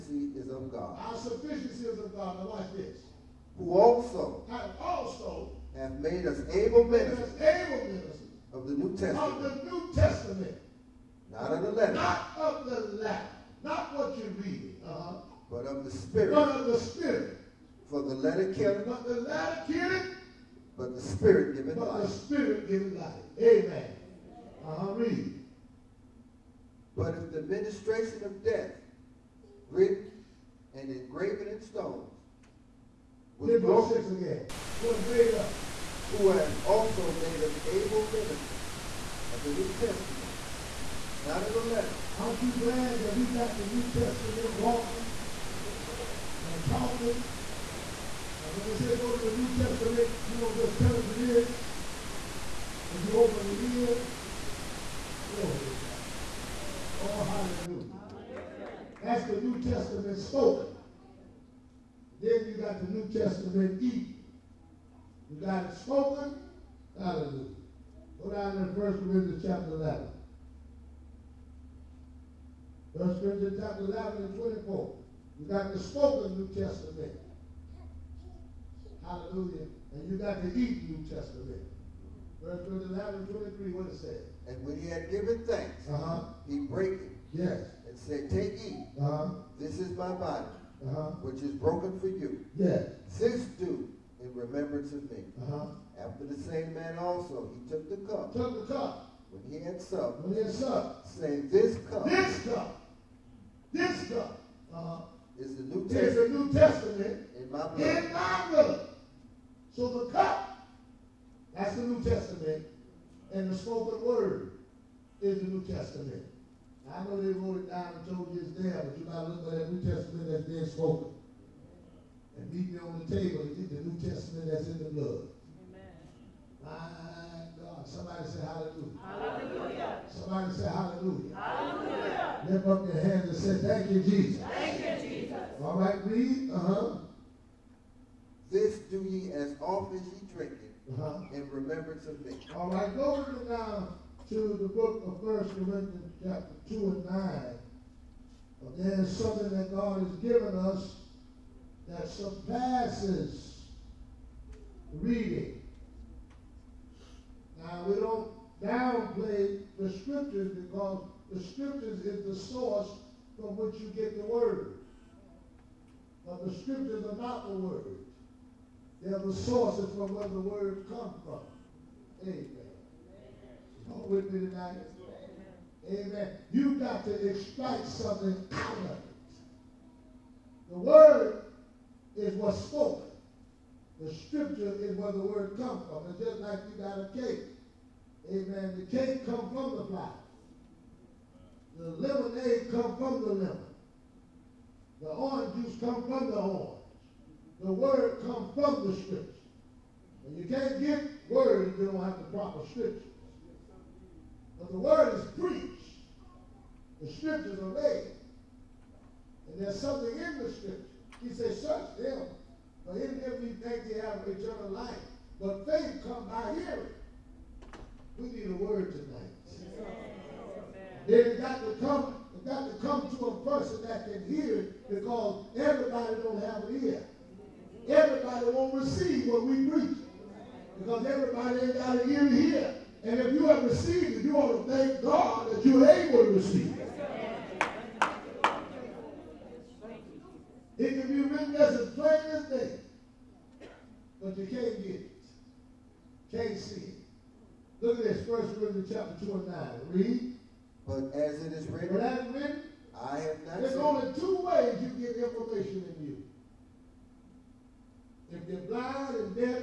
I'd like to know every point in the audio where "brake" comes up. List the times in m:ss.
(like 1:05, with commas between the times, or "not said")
1:26.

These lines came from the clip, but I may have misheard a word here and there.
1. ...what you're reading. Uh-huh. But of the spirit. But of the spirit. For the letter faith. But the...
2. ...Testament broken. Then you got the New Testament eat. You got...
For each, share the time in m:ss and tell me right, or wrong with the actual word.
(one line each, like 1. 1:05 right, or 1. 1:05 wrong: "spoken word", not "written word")
1. 0:13 wrong: "killeth", not "faith"
2. 0:59 wrong: "spoken", not "broken".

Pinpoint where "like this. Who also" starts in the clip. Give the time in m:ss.
0:02.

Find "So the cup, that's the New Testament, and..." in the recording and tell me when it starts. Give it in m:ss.
1:49.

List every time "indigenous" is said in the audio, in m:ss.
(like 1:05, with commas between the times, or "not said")
not said.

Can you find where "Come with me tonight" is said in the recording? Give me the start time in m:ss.
2:53.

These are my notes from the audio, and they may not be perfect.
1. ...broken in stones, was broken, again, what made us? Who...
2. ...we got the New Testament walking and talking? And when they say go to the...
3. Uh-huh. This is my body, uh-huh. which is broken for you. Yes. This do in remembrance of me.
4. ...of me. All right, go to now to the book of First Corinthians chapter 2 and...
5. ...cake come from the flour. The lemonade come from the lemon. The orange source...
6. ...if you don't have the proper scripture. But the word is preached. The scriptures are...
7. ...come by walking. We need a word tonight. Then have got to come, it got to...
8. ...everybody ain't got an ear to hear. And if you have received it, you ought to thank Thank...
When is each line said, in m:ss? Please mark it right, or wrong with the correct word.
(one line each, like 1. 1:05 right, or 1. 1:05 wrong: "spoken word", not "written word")
1. 0:30 wrong: "engraven", not "broken"
2. 0:43 right
3. 1:28 right
4. 2:22 right
5. 3:08 wrong: "juice", not "source"
6. 3:21 right
7. 3:36 wrong: "hearing", not "walking"
8. 3:51 wrong: "God", not "Thank".